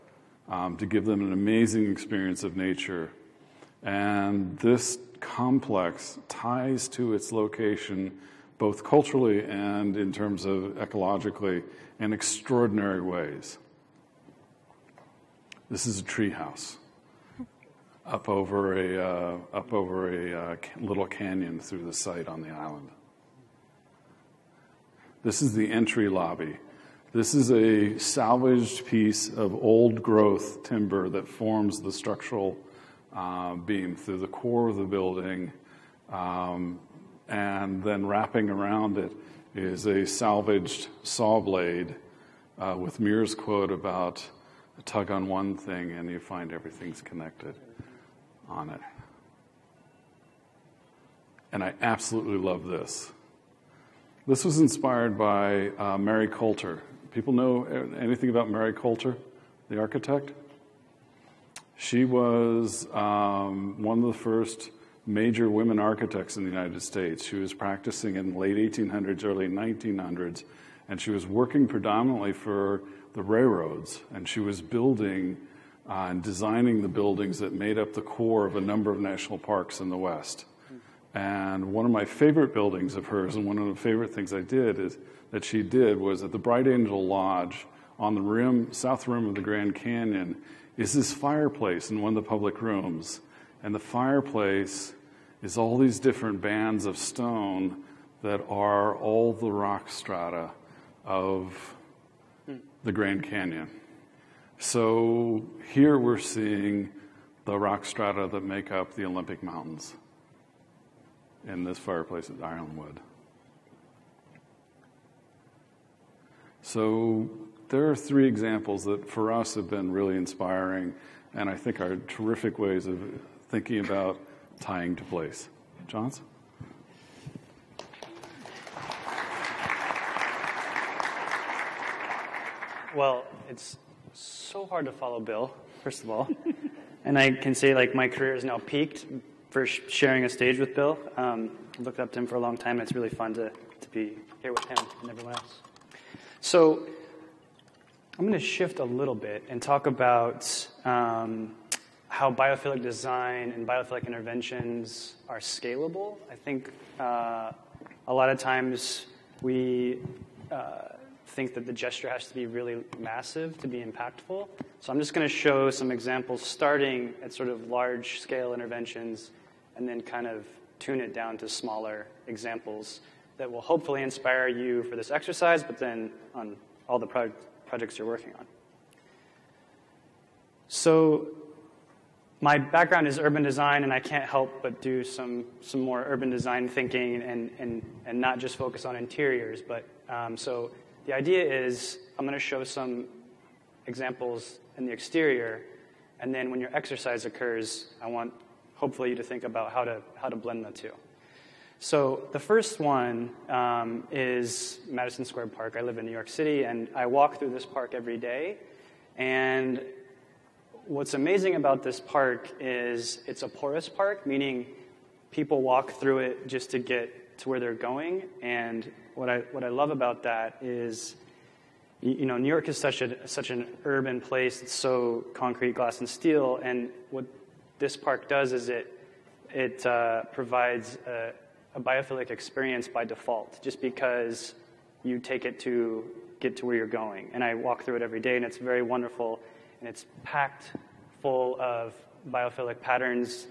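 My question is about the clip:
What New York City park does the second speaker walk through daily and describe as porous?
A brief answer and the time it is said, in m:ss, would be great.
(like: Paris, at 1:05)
Madison Square Park, at 3:24.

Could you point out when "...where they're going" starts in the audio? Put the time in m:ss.
3:37.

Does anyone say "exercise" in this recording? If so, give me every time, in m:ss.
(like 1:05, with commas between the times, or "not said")
2:55, 3:16.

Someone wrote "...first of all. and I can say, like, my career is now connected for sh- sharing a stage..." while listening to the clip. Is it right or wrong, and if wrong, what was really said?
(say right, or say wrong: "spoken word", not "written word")
wrong: "peaked", not "connected".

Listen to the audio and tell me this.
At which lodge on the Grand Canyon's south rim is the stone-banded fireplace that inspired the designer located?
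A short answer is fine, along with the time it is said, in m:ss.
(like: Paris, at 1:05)
Bright Angel Lodge, at 1:26.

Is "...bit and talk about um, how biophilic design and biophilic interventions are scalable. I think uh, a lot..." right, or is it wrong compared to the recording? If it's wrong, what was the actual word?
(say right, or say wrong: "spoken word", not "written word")
right.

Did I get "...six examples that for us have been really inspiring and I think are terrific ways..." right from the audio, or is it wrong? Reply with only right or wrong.
wrong.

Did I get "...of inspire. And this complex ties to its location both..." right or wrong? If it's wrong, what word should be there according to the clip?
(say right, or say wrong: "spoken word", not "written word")
wrong: "nature", not "inspire".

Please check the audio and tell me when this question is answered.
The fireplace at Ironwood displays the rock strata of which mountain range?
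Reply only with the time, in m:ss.
1:49.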